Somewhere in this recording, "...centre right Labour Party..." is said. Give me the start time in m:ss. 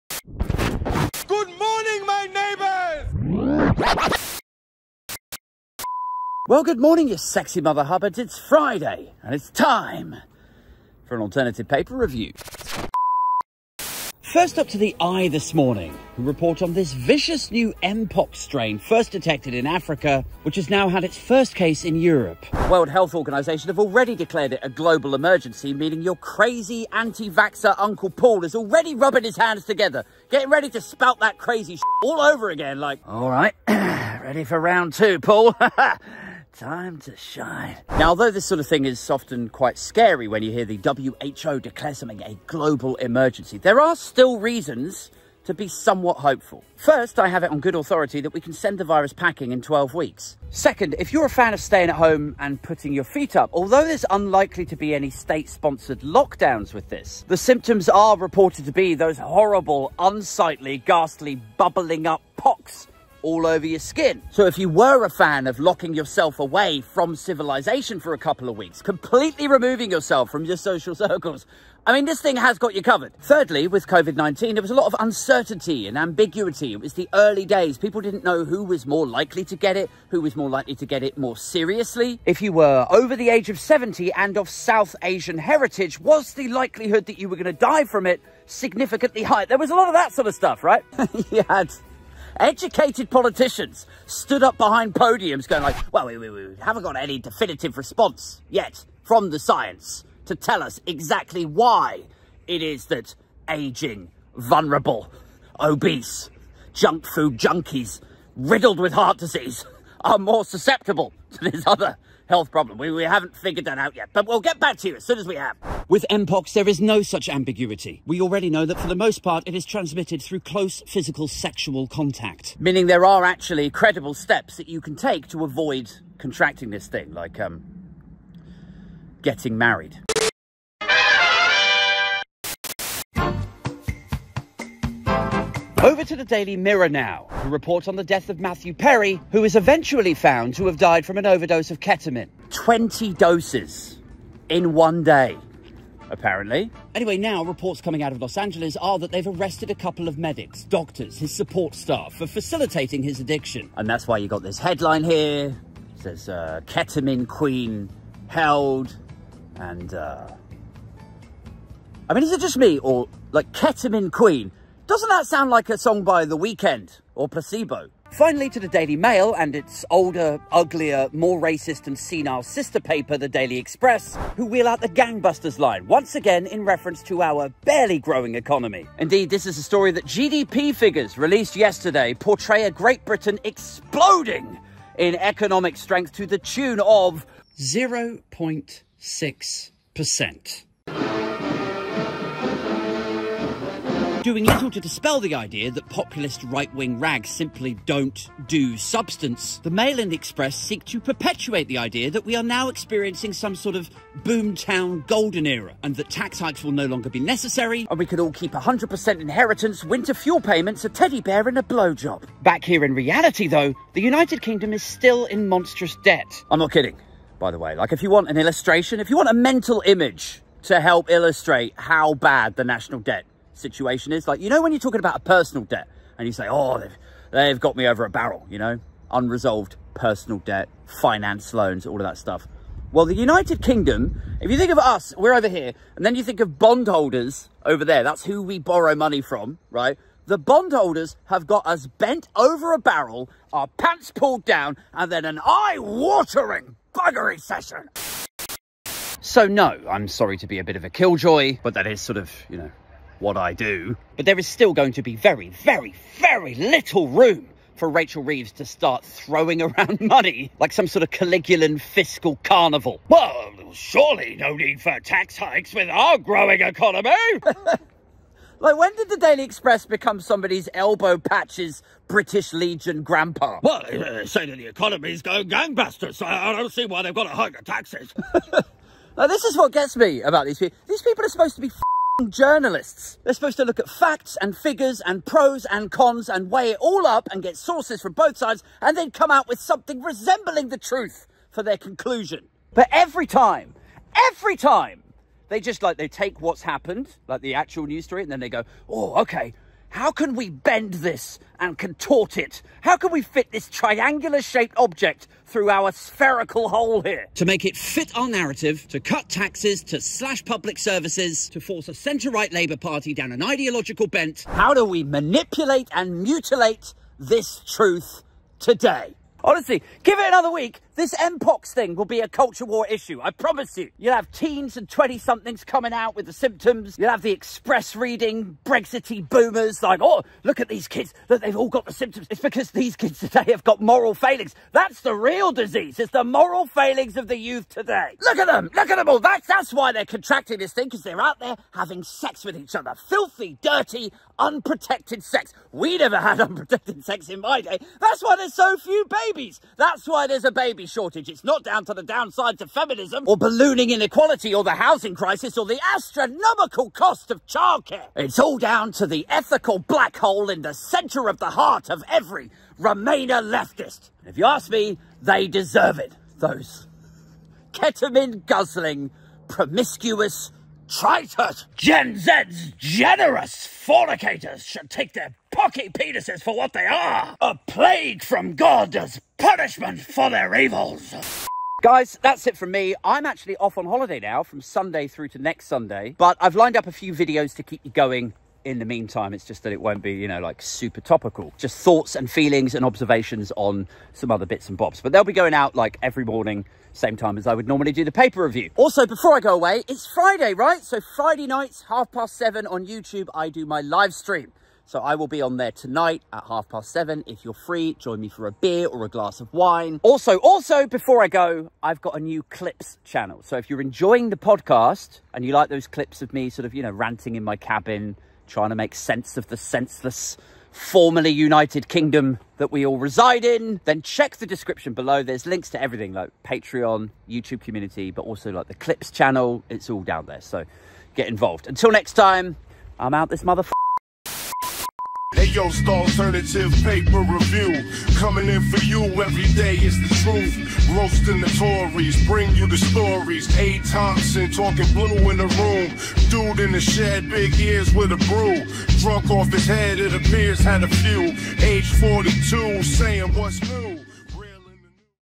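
5:11.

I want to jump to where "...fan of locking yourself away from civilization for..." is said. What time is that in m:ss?
1:05.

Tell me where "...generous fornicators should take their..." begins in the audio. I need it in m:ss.
6:12.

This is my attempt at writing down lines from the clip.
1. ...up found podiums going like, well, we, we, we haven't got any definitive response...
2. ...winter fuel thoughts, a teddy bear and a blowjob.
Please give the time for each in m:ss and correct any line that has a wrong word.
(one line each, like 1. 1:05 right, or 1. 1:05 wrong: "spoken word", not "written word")
1. 1:34 wrong: "behind", not "found"
2. 3:29 wrong: "payments", not "thoughts".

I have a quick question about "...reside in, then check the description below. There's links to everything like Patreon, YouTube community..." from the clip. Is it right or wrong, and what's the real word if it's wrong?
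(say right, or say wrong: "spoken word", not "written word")
right.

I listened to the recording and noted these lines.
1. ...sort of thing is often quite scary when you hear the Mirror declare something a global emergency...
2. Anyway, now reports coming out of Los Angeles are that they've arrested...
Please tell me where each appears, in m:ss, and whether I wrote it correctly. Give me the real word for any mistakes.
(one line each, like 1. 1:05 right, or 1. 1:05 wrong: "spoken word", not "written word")
1. 0:38 wrong: "WHO", not "Mirror"
2. 2:26 right.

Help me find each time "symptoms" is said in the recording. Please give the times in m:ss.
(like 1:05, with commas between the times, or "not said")
0:57, 5:26, 5:31.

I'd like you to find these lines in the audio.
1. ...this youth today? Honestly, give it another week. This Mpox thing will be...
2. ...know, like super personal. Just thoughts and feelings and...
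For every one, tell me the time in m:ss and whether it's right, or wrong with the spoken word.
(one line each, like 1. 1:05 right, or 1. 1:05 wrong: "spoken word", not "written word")
1. 5:17 wrong: "truth", not "youth"
2. 6:30 wrong: "topical", not "personal".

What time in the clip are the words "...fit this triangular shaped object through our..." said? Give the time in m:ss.
5:03.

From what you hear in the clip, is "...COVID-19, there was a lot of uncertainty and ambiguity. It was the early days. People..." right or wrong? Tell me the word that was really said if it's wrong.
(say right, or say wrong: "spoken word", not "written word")
right.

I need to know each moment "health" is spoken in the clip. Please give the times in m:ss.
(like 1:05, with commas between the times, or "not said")
0:22, 1:52.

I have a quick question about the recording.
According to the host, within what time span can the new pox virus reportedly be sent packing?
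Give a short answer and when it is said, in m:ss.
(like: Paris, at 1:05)
12 weeks, at 0:49.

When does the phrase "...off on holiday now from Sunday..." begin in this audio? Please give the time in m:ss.
6:23.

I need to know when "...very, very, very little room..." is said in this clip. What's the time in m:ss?
4:15.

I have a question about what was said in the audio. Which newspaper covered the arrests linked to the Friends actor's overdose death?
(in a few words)
Daily Mirror.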